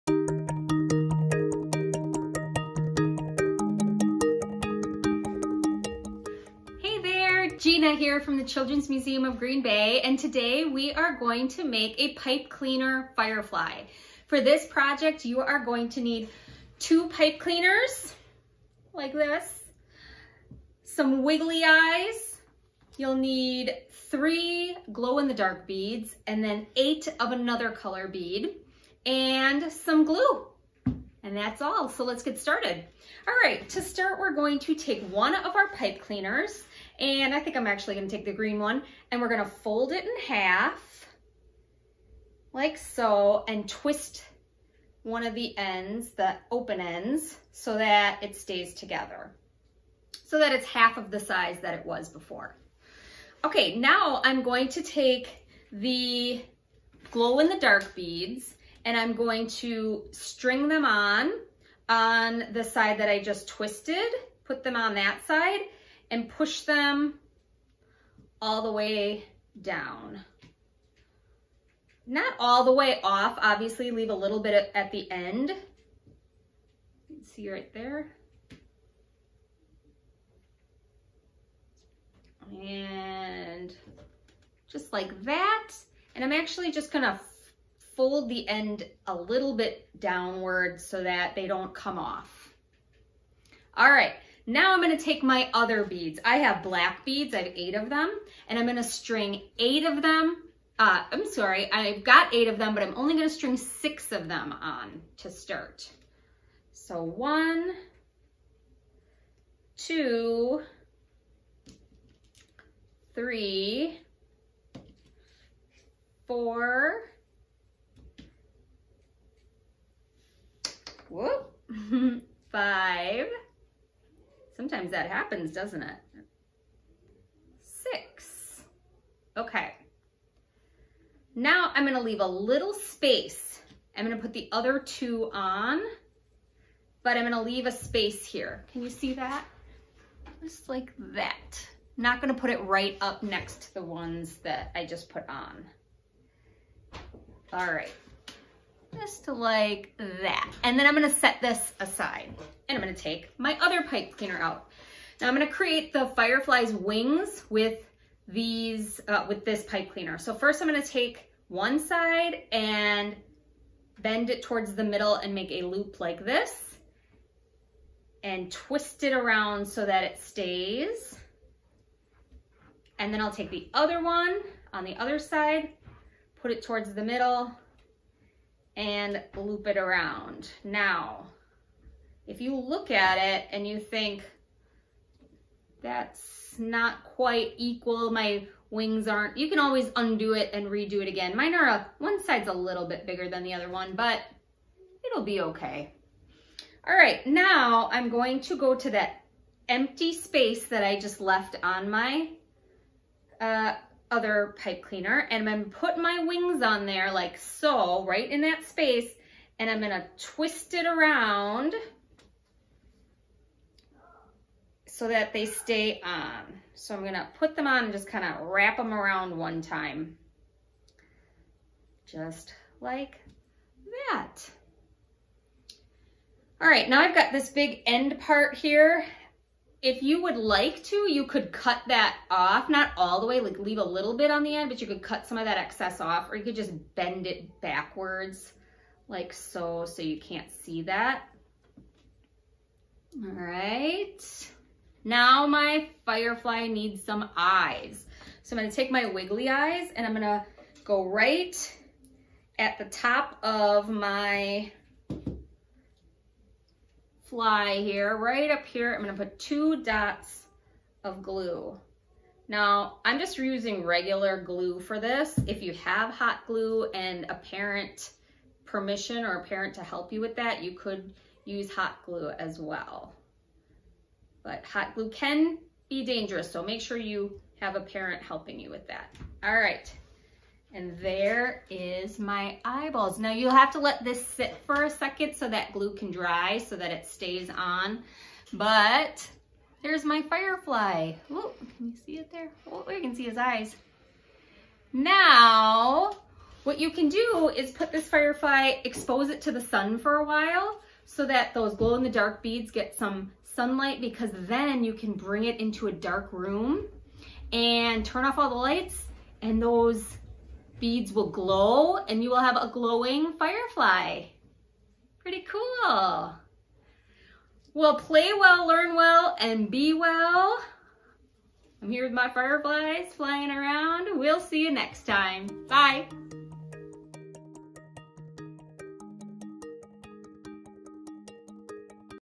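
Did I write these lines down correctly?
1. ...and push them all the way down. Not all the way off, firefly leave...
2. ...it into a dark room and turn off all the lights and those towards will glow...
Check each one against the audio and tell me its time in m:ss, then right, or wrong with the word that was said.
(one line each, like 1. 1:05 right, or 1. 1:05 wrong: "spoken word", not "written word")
1. 1:06 wrong: "obviously", not "firefly"
2. 5:05 wrong: "beads", not "towards".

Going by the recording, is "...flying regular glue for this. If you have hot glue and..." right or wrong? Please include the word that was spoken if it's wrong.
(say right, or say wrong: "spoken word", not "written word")
wrong: "using", not "flying".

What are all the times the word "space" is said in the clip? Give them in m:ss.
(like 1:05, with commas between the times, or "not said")
2:12, 2:17, 3:20, 3:28.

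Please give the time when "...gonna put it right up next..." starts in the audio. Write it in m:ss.
2:22.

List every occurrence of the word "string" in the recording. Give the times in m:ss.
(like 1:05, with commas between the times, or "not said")
1:00, 1:38, 1:43.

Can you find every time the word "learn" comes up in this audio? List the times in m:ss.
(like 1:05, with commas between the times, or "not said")
5:18.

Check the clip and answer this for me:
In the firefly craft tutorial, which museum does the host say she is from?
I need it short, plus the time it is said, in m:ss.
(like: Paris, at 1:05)
Children's Museum of Green Bay, at 0:08.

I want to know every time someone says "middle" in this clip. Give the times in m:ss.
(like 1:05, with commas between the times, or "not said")
2:44, 2:57.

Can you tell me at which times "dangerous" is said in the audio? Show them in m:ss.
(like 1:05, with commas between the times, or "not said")
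4:36.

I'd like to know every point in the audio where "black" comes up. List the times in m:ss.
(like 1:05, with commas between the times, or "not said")
1:36.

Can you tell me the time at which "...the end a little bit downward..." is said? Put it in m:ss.
1:28.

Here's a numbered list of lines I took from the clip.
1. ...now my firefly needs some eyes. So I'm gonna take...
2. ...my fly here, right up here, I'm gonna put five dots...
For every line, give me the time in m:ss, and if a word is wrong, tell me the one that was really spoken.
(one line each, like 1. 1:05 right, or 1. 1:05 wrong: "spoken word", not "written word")
1. 4:05 right
2. 4:13 wrong: "two", not "five".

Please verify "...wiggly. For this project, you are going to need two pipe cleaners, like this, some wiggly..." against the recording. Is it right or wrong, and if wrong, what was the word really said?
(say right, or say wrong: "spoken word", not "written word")
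wrong: "firefly", not "wiggly".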